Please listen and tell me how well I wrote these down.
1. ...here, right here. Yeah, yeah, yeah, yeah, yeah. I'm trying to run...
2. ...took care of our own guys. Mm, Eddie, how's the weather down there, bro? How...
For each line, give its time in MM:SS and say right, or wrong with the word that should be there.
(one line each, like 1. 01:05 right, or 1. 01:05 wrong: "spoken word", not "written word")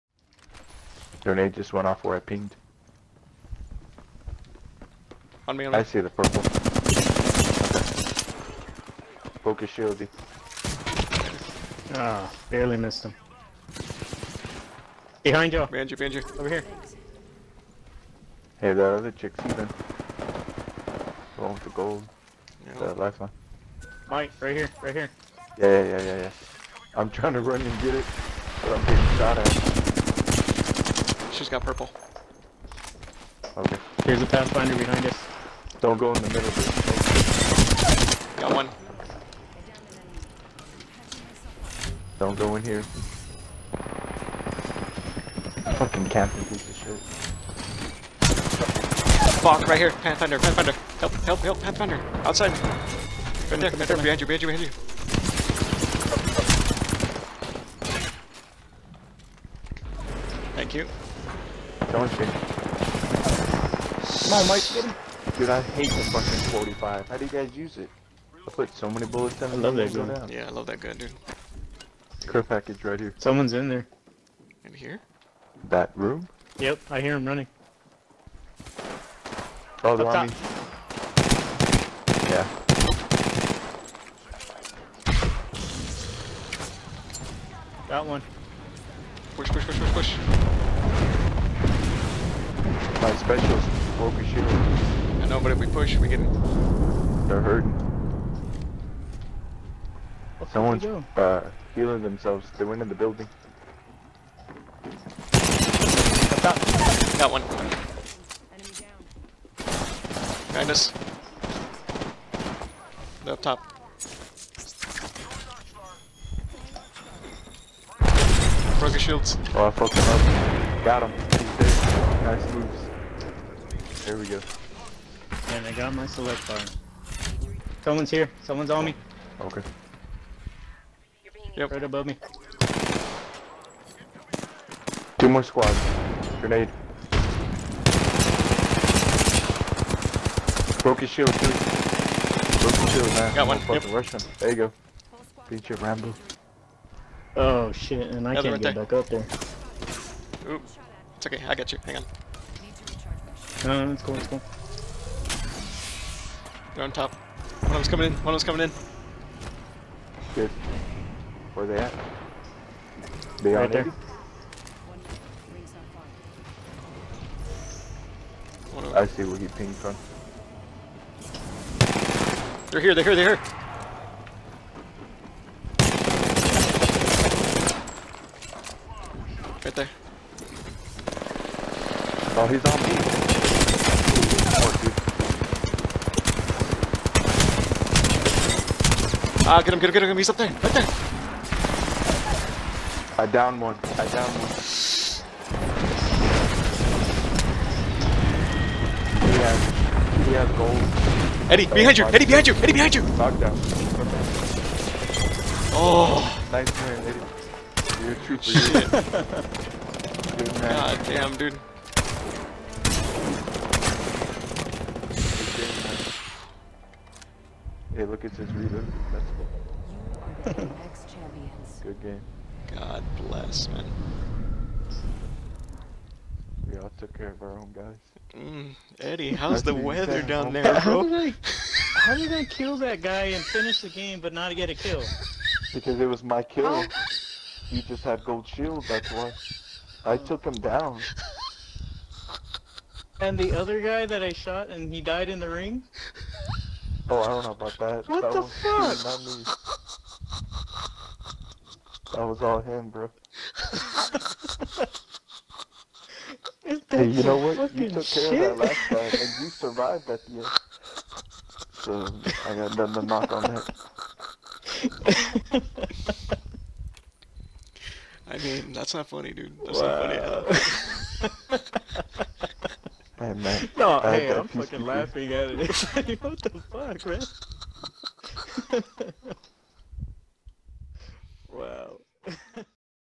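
1. 00:24 right
2. 03:46 right.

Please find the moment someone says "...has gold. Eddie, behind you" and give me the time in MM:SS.
03:20.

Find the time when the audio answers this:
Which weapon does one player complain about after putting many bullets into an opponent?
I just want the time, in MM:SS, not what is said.
01:05.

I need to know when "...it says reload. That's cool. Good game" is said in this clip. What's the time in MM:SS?
03:38.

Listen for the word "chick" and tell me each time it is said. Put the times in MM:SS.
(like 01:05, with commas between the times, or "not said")
00:19.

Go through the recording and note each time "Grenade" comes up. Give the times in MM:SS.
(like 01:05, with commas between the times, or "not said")
00:01, 02:16.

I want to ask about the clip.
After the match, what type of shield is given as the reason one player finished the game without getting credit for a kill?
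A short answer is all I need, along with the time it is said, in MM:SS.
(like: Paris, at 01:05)
gold shield, at 03:58.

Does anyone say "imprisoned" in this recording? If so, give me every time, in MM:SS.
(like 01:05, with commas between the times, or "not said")
not said.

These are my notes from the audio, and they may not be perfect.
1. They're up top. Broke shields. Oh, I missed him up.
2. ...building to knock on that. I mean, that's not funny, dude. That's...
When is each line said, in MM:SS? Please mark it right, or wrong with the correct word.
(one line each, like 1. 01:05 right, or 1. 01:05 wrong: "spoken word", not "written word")
1. 01:53 wrong: "fucked", not "missed"
2. 04:22 wrong: "nothing", not "building".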